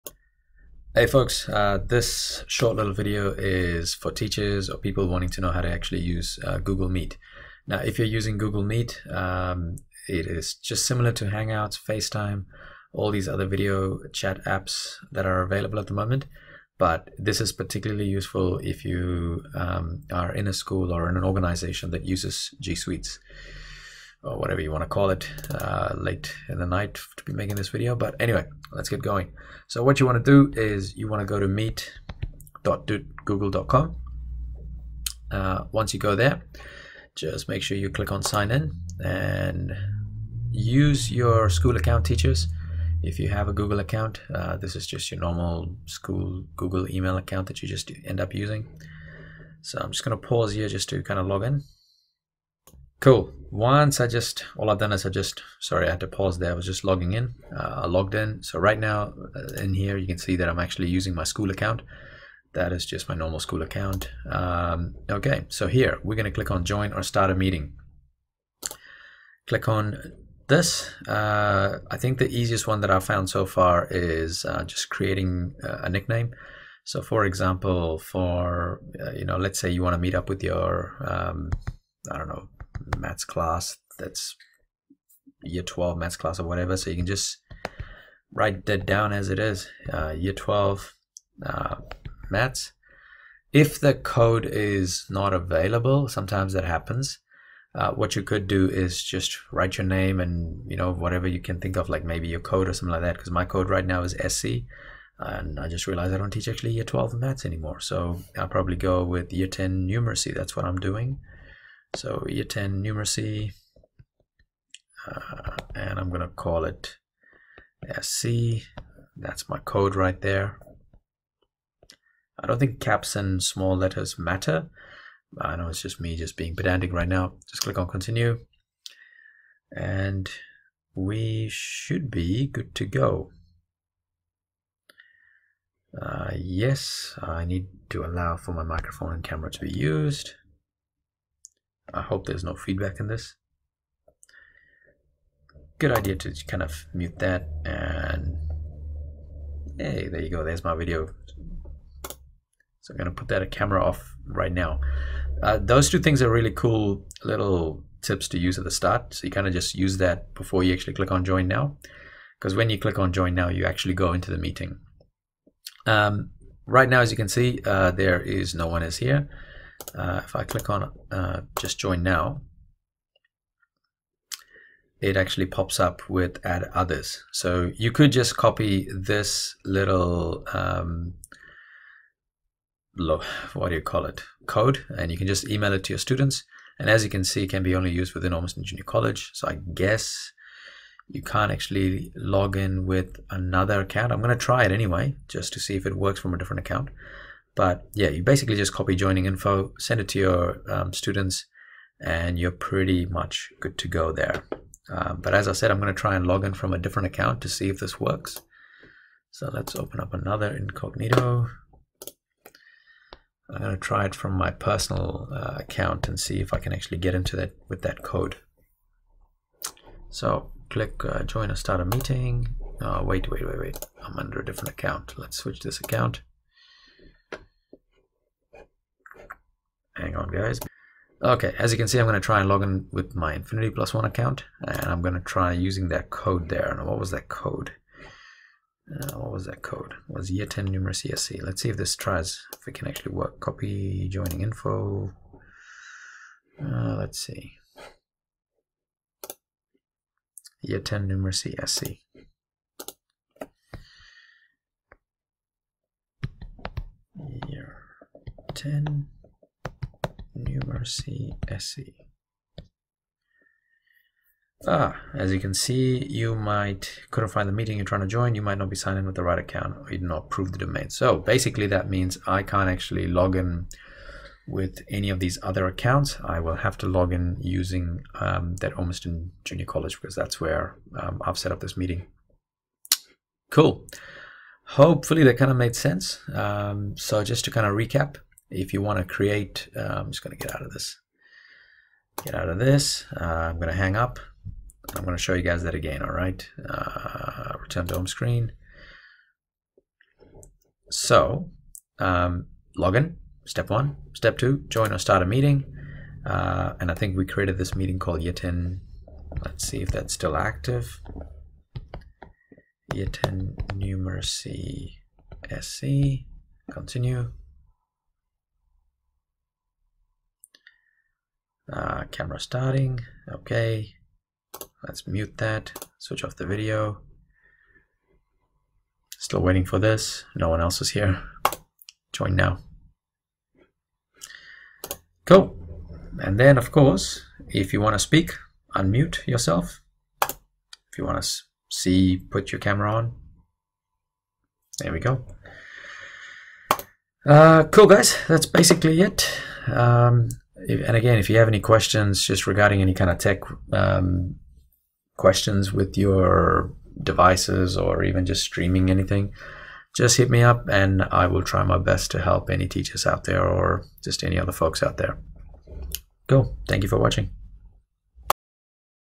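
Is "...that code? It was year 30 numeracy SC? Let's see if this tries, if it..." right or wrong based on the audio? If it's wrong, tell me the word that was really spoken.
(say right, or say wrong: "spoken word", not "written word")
wrong: "10", not "30".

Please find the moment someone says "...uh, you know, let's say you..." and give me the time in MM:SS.
01:19.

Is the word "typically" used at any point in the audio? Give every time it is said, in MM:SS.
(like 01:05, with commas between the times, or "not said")
not said.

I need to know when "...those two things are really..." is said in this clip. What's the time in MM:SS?
02:35.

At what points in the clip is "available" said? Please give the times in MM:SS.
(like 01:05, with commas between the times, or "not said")
00:15, 01:35.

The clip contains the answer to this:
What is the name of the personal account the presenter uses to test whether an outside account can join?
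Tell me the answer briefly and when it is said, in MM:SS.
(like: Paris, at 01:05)
Infinity Plus One, at 03:53.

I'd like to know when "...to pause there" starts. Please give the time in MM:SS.
00:56.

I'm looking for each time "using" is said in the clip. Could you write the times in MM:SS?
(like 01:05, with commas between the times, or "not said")
00:08, 00:48, 01:00, 03:55, 04:37.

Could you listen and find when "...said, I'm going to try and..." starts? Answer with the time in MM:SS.
03:25.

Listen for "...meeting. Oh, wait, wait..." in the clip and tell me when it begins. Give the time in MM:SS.
03:41.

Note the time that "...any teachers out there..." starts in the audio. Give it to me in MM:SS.
06:02.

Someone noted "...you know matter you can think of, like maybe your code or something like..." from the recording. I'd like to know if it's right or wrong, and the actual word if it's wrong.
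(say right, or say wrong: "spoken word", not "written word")
wrong: "whatever", not "matter".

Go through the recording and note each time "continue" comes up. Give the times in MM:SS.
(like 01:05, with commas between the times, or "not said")
02:07, 05:16.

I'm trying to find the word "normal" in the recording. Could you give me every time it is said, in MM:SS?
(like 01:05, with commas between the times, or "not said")
00:45, 01:03.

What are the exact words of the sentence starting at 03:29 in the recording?
So let's open up another incognito.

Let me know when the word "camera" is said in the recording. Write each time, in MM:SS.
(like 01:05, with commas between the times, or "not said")
02:19, 02:33, 05:22, 05:42.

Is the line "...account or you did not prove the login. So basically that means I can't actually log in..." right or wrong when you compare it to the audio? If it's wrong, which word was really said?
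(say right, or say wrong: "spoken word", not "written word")
wrong: "domain", not "login".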